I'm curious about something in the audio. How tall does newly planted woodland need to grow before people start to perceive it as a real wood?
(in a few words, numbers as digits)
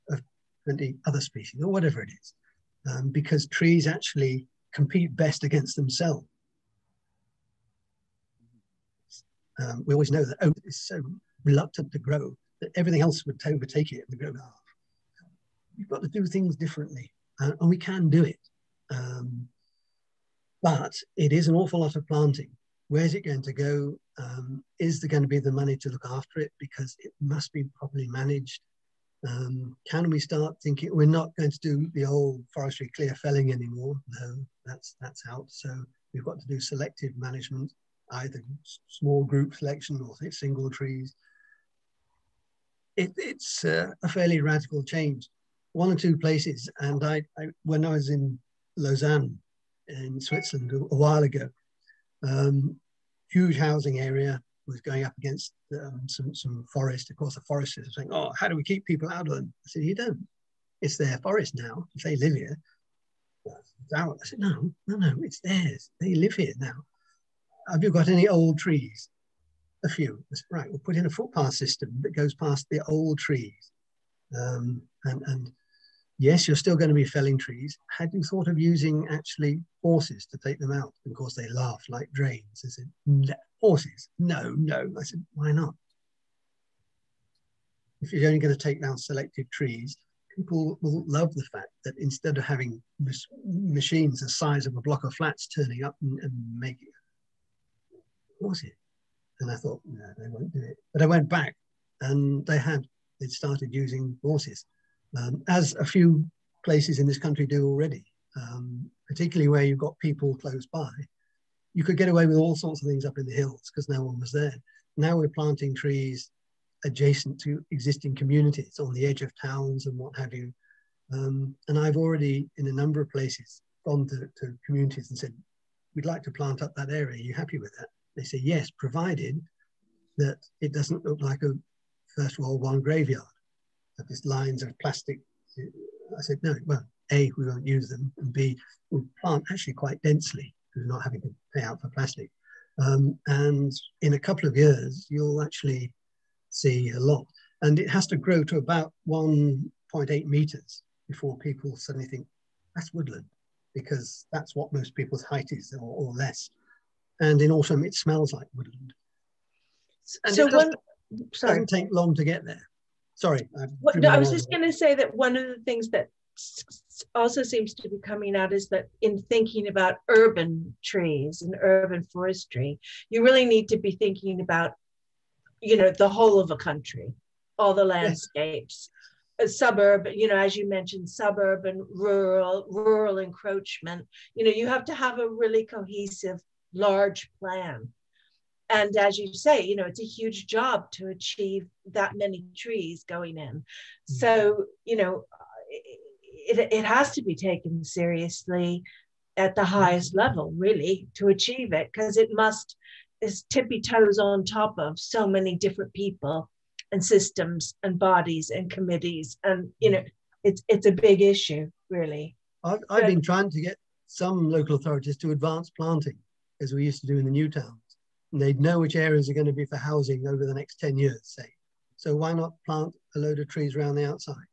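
1.8 meters.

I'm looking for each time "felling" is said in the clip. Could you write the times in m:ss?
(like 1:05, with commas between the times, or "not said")
0:33, 1:17.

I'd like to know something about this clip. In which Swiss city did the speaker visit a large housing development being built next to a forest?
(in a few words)
Lausanne.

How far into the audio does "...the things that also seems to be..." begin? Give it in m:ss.
2:45.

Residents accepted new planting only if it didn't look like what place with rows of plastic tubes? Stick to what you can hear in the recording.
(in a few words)
A First World War graveyard.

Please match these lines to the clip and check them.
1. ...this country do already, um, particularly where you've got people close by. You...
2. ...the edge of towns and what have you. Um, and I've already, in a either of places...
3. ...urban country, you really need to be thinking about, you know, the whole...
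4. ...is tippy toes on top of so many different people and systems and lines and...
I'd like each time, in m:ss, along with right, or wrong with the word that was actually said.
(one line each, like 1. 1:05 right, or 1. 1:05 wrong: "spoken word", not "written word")
1. 1:47 right
2. 1:58 wrong: "number", not "either"
3. 2:51 wrong: "forestry", not "country"
4. 3:23 wrong: "bodies", not "lines".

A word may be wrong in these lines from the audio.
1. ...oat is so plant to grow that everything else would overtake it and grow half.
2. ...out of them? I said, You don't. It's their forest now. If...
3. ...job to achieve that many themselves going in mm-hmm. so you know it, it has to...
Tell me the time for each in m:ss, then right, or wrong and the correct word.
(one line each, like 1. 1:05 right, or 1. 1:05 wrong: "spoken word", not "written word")
1. 0:10 wrong: "reluctant", not "plant"
2. 0:59 right
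3. 3:10 wrong: "trees", not "themselves".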